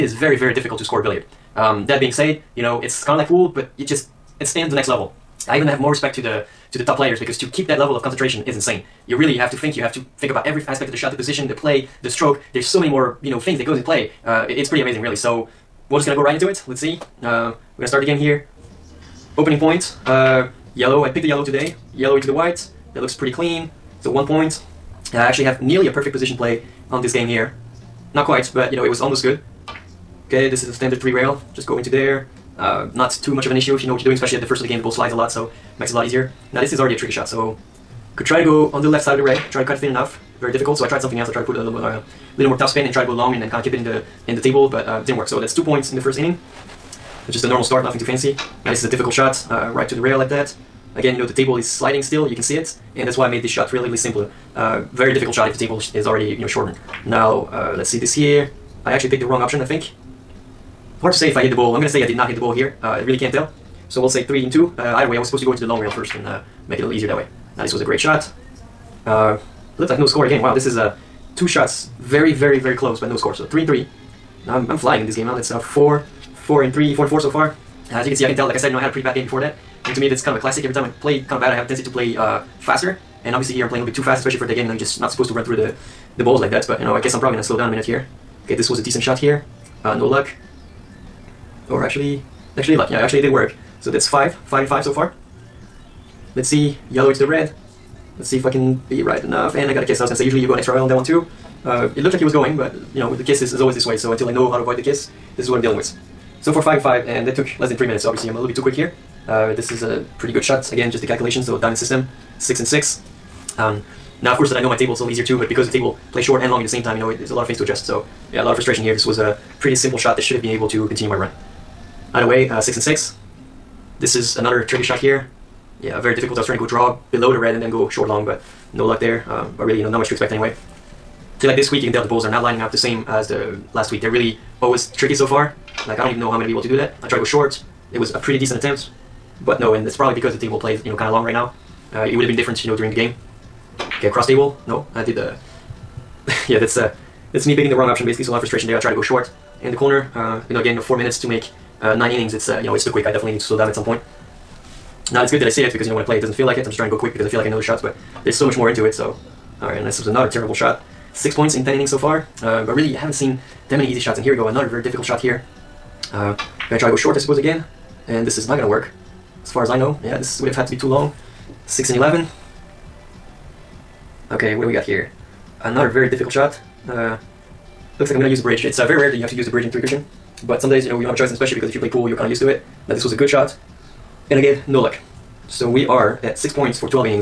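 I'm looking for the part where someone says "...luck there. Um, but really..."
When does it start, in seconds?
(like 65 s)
128 s.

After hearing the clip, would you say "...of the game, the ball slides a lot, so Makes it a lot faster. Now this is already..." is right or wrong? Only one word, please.
wrong.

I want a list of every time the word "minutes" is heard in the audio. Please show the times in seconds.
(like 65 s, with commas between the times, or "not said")
87 s, 107 s, 150 s.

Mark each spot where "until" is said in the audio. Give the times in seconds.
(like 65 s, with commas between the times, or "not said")
104 s.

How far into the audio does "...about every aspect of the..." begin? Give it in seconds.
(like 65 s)
10 s.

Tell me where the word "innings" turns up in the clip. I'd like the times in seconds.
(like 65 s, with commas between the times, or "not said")
46 s, 152 s, 161 s.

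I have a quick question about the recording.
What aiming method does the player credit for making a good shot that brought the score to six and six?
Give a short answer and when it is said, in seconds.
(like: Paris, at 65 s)
Diamond system, at 111 s.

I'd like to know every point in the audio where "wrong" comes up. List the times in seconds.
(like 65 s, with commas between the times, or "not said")
59 s, 147 s.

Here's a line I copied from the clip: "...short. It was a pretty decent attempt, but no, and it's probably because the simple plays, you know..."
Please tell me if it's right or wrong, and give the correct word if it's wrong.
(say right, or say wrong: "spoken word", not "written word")
wrong: "table", not "simple".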